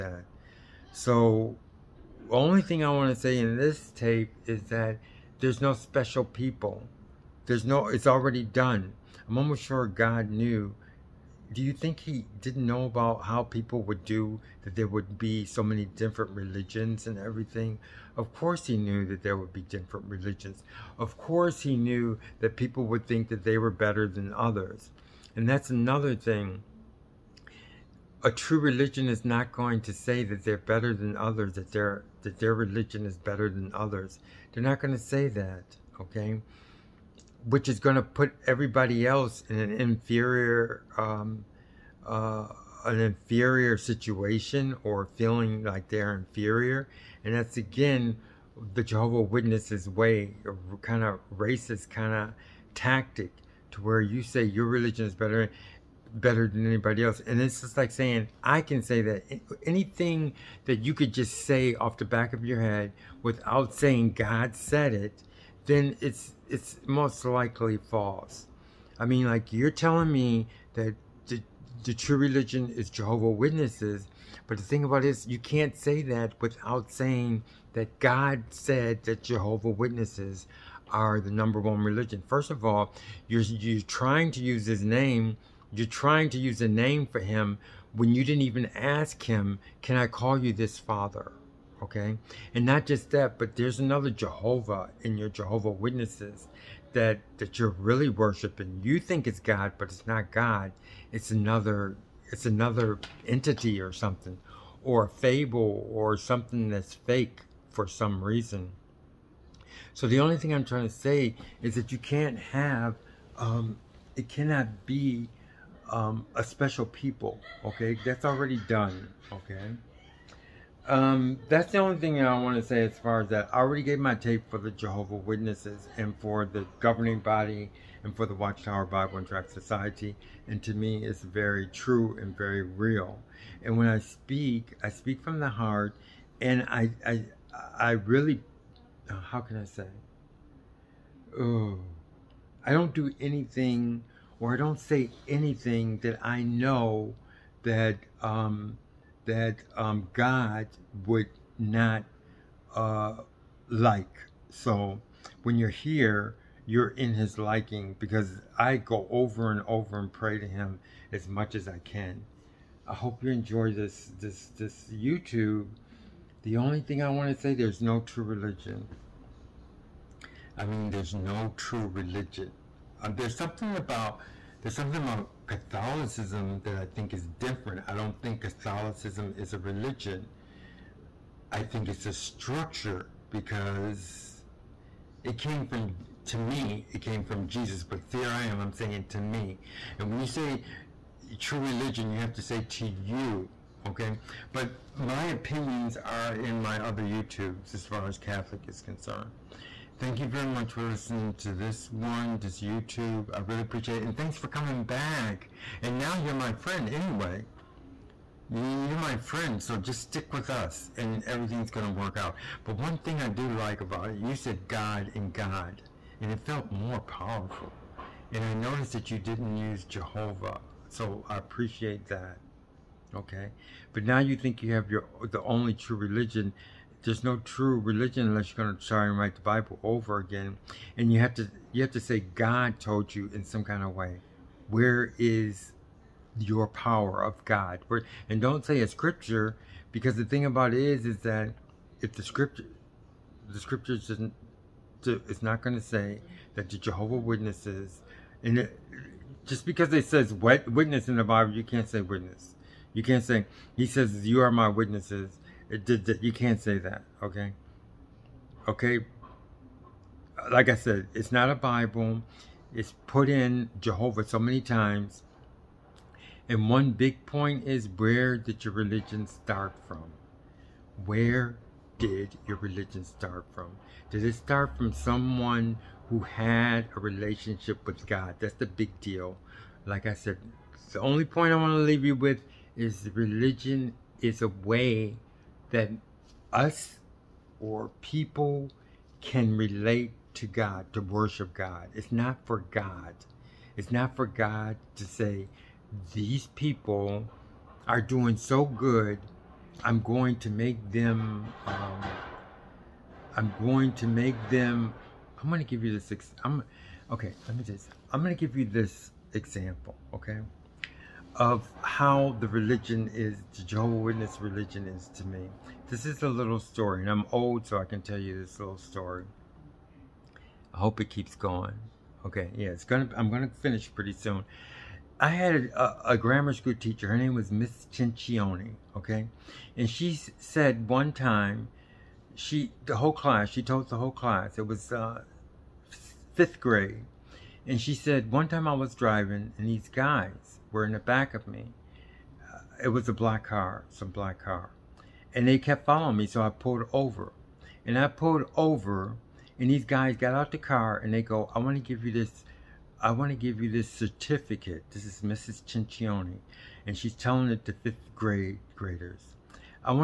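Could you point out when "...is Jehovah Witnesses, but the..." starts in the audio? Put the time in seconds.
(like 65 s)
72 s.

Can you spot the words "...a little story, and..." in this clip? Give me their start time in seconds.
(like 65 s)
316 s.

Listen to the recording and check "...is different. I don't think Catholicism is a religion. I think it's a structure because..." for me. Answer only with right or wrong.
right.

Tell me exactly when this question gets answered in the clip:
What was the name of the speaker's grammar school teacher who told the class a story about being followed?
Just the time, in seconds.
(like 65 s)
327 s.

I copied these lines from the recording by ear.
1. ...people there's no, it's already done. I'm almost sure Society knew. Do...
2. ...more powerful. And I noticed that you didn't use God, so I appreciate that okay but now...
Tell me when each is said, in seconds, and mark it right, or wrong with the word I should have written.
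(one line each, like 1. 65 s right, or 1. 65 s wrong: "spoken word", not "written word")
1. 6 s wrong: "God", not "Society"
2. 216 s wrong: "Jehovah", not "God".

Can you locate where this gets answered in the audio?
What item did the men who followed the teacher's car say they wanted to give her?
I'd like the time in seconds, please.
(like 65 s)
353 s.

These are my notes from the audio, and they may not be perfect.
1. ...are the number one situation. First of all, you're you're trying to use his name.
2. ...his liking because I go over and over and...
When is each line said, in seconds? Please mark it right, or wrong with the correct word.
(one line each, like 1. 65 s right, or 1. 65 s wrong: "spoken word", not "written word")
1. 80 s wrong: "religion", not "situation"
2. 157 s right.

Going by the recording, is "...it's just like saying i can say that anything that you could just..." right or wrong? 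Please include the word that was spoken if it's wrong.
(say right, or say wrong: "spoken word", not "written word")
right.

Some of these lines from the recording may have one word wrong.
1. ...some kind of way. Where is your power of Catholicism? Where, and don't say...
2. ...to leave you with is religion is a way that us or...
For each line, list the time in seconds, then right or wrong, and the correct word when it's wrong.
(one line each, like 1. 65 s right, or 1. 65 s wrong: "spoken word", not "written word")
1. 233 s wrong: "God", not "Catholicism"
2. 281 s right.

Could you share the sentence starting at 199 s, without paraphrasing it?
Thank you very much for listening to this one, this YouTube.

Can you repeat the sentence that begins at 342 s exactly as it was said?
Uh, it was a black car, some black car.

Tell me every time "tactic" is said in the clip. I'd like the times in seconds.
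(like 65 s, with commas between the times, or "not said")
52 s.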